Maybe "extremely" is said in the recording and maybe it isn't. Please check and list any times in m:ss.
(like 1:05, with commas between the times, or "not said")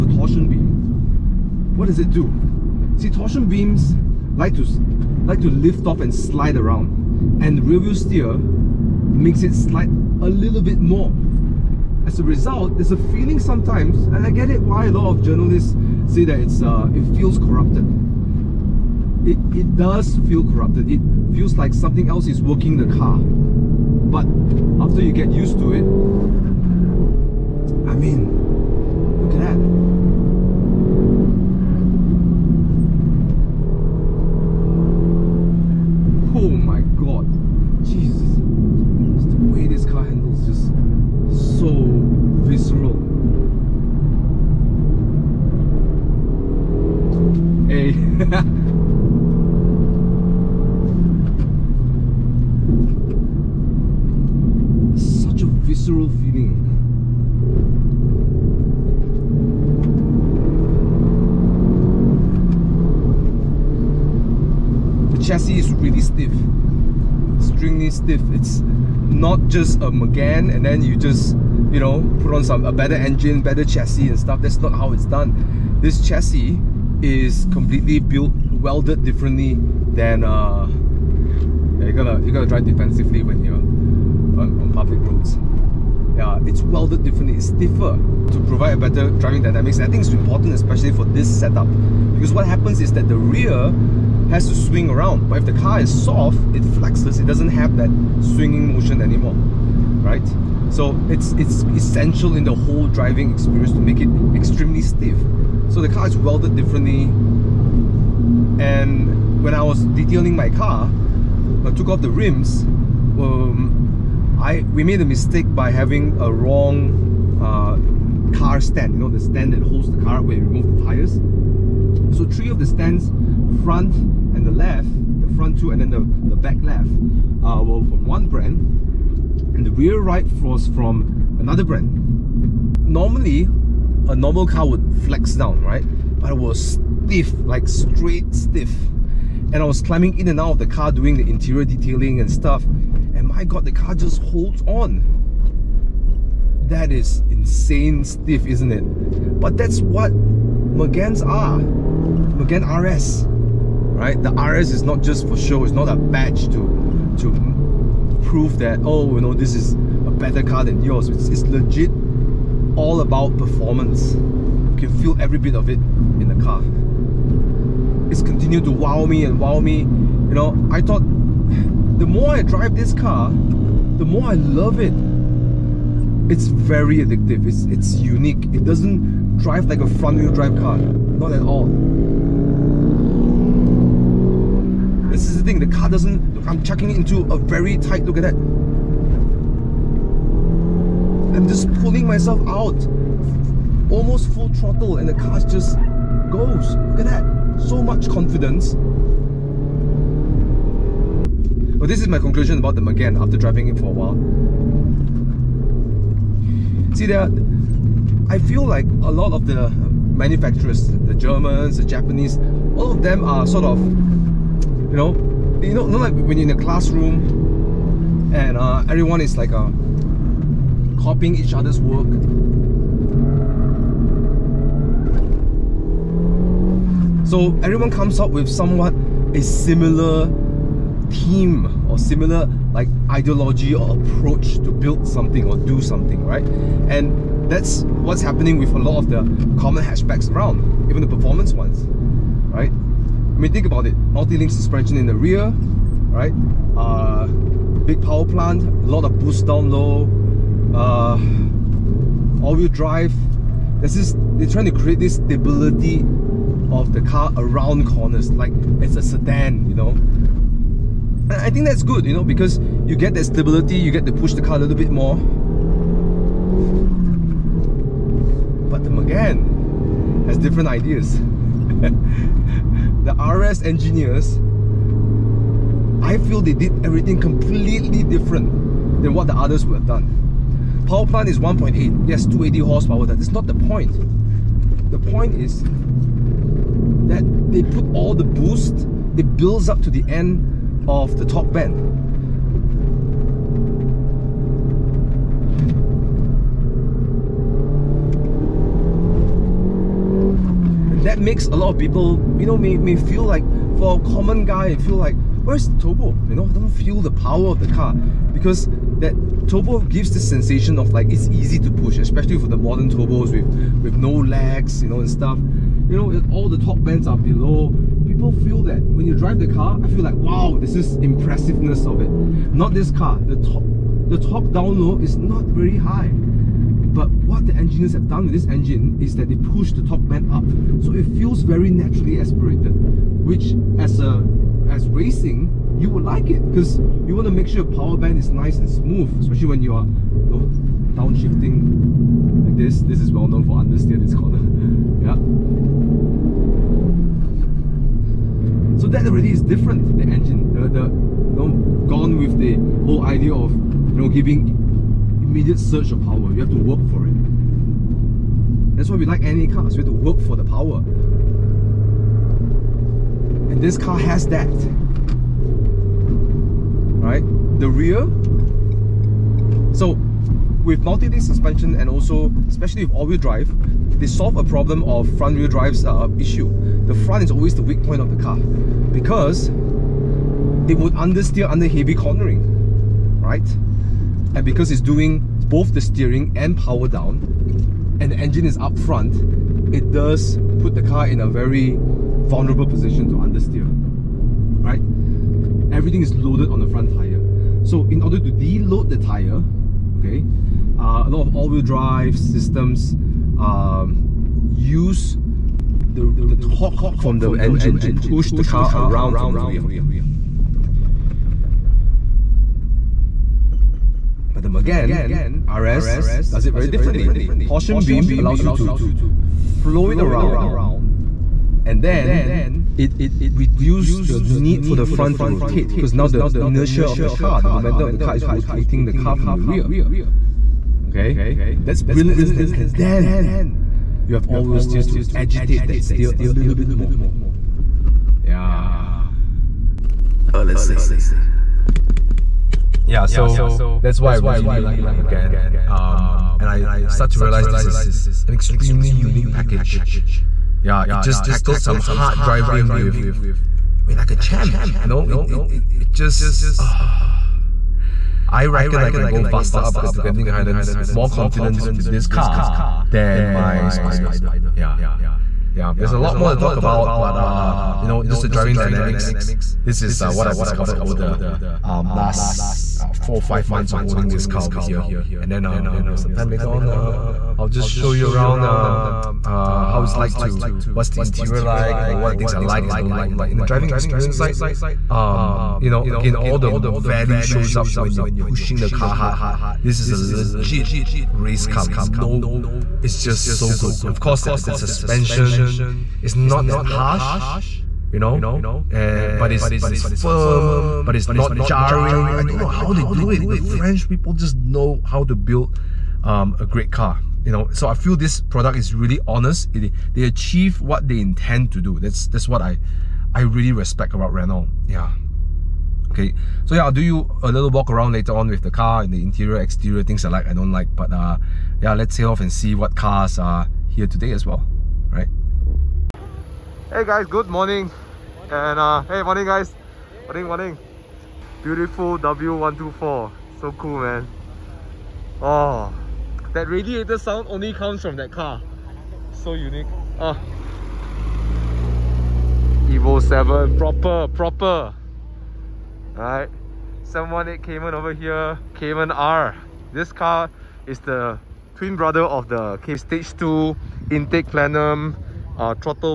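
1:44, 7:28.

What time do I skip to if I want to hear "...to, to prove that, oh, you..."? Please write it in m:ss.
2:36.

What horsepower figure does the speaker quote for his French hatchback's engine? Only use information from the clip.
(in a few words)
280.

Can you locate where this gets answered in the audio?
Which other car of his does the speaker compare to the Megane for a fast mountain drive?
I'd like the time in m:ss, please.
7:43.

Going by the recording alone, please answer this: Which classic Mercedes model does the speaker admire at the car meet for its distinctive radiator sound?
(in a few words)
W124.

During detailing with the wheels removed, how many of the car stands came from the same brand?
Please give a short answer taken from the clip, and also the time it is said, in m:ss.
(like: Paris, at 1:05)
3, at 2:02.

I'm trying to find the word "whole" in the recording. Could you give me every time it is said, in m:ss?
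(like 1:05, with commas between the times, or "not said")
1:42, 5:52.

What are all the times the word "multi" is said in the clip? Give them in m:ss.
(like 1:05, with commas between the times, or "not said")
4:03, 6:10.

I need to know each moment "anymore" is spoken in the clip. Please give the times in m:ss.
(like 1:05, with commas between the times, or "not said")
1:39.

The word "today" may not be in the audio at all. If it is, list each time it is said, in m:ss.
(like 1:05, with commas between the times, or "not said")
8:43.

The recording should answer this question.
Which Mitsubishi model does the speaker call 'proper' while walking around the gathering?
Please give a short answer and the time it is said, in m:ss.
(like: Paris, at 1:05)
Evo 7, at 9:02.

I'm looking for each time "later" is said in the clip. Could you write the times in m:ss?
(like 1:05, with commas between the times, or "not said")
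7:56, 8:37.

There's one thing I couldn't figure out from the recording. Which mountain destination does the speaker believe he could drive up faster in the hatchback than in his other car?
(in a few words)
Genting Highlands.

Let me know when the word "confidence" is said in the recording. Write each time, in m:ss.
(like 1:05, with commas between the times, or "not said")
3:18, 7:41.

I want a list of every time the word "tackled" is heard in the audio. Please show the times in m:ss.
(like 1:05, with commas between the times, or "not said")
7:31.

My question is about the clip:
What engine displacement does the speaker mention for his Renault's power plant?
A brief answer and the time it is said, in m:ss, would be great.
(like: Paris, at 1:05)
1.8, at 4:41.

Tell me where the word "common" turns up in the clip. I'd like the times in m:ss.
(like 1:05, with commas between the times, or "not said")
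3:59, 5:04.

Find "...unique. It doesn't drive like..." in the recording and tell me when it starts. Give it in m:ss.
2:57.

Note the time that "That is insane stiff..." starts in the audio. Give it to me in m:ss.
2:26.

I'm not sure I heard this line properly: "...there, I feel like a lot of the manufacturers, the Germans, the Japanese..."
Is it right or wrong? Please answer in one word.
right.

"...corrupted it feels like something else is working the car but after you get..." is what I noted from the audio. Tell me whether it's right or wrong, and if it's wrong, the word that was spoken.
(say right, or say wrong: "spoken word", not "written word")
right.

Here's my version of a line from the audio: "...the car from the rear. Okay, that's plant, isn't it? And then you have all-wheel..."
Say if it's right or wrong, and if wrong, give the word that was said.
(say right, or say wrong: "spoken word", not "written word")
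wrong: "brilliant", not "plant".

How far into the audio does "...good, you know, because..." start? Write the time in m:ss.
4:21.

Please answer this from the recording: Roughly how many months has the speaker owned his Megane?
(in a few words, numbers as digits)
4 or 5.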